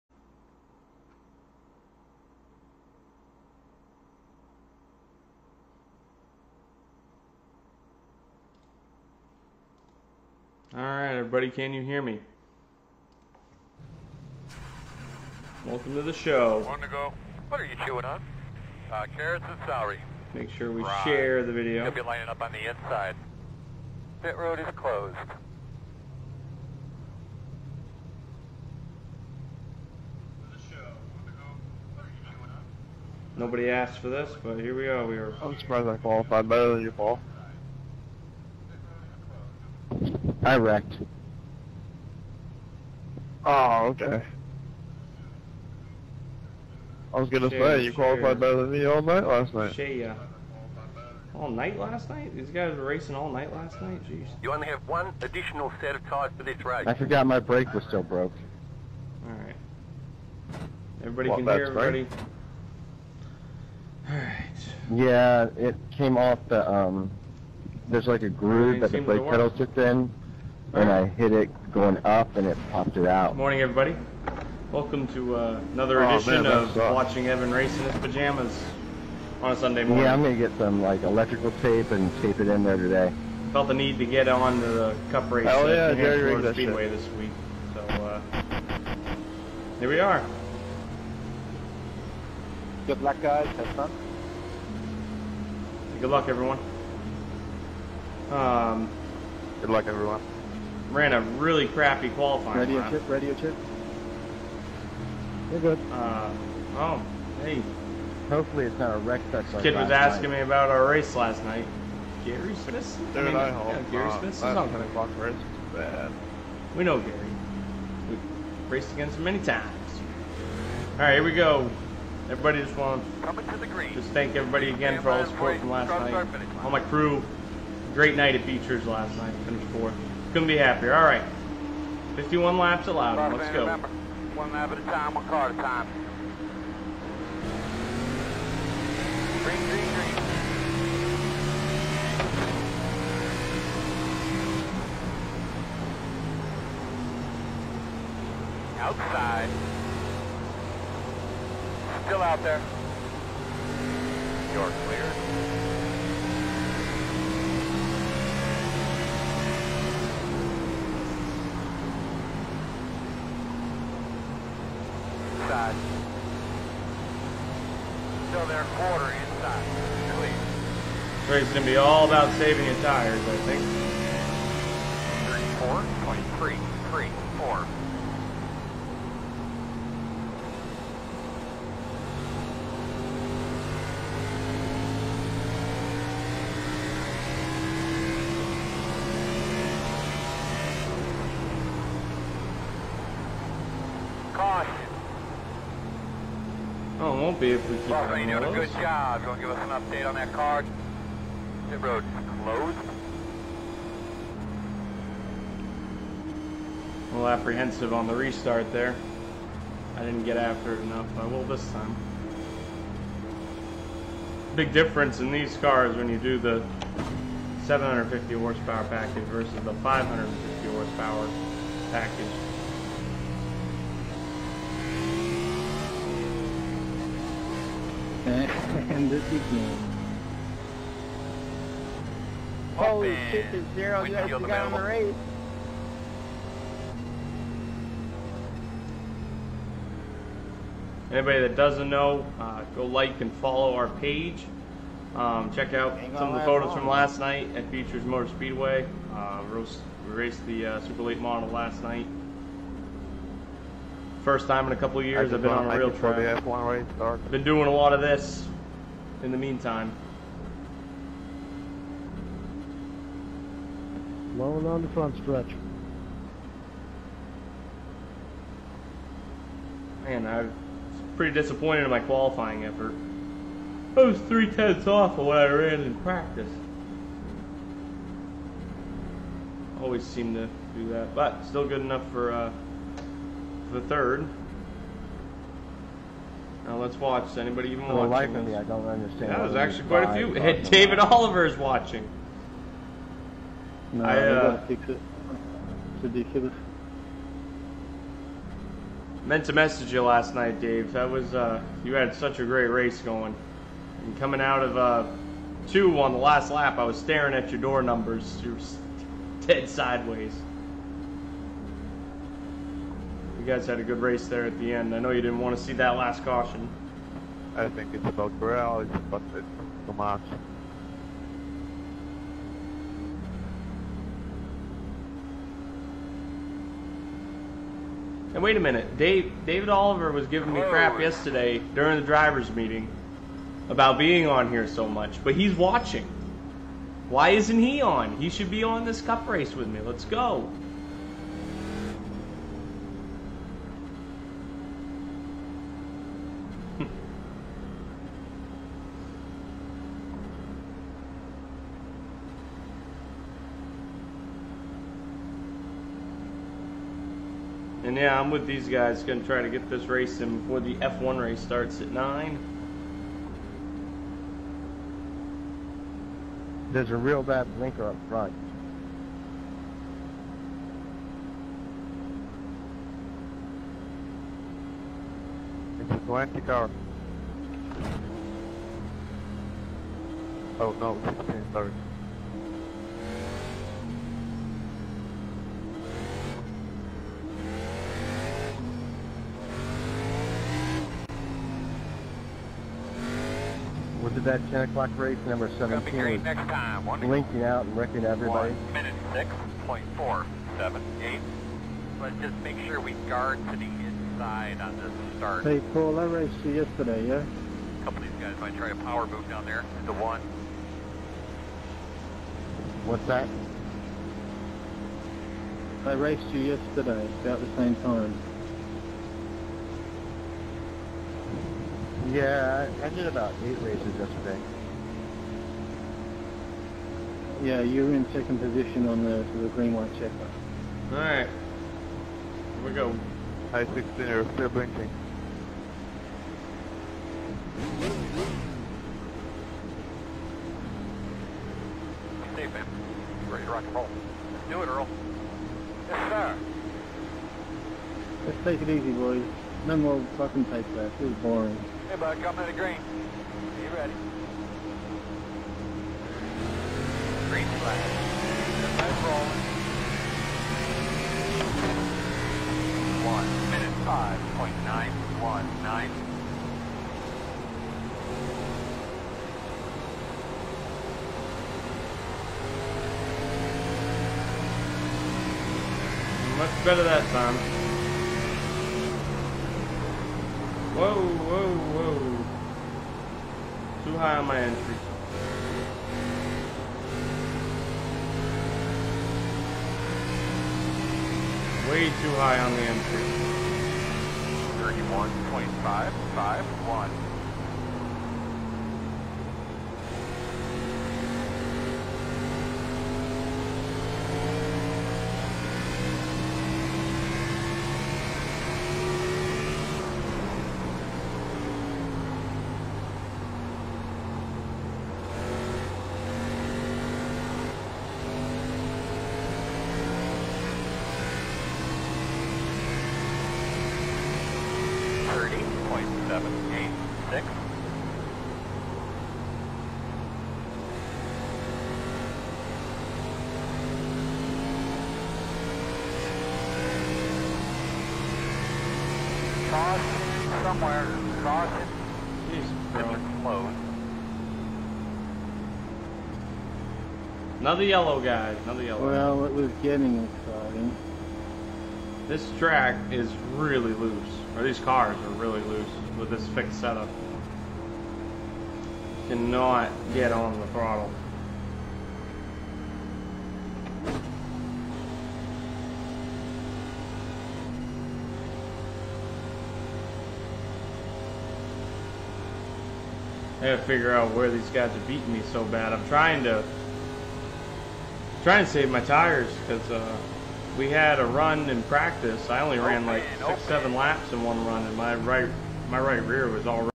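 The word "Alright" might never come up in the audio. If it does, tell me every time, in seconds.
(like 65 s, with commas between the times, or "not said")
59 s, 64 s, 430 s.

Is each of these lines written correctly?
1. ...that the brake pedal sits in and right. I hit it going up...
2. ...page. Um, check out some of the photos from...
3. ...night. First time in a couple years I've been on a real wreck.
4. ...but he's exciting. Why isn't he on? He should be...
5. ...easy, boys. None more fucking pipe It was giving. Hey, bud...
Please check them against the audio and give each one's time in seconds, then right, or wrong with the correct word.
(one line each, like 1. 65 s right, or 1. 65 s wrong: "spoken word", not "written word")
1. 68 s right
2. 243 s right
3. 251 s wrong: "track", not "wreck"
4. 335 s wrong: "watching", not "exciting"
5. 448 s wrong: "boring", not "giving".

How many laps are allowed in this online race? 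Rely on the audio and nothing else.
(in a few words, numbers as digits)
51.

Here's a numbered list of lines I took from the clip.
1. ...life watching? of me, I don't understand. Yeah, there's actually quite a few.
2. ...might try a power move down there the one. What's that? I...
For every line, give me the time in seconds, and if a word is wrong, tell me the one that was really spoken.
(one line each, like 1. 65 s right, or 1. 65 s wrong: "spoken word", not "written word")
1. 288 s right
2. 408 s right.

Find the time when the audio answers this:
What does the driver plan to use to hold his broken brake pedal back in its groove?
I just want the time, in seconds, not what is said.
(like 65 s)
81 s.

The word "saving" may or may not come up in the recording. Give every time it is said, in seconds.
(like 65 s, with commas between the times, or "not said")
172 s.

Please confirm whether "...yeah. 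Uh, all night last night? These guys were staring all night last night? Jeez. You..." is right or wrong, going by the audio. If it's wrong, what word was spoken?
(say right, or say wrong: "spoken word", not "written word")
wrong: "racing", not "staring".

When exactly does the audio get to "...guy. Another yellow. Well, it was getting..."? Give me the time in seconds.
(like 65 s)
547 s.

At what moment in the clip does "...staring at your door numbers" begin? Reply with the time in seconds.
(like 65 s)
306 s.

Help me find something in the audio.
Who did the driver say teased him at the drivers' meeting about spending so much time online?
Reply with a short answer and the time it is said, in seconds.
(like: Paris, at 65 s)
David Oliver, at 329 s.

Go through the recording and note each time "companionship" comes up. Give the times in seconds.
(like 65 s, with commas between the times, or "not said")
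not said.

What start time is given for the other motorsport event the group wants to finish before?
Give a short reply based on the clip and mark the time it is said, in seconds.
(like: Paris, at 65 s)
9, at 361 s.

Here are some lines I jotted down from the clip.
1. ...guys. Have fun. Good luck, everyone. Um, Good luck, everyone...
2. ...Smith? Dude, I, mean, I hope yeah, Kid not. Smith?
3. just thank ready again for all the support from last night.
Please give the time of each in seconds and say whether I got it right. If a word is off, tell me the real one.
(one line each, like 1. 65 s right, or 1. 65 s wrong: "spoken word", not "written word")
1. 93 s right
2. 112 s wrong: "Gary", not "Kid"
3. 123 s wrong: "everybody", not "ready".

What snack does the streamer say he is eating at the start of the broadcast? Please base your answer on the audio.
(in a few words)
Carrots and celery.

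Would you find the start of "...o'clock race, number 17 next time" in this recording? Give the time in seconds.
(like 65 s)
394 s.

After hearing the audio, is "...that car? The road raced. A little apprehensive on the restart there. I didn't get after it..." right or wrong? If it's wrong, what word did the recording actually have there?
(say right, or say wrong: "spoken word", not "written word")
wrong: "closed", not "raced".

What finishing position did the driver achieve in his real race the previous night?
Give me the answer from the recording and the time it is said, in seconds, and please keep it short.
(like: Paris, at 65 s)
Fourth, at 129 s.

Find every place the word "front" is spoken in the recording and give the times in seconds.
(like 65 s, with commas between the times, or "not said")
264 s, 368 s.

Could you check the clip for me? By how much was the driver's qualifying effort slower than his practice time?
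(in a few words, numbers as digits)
Three tenths.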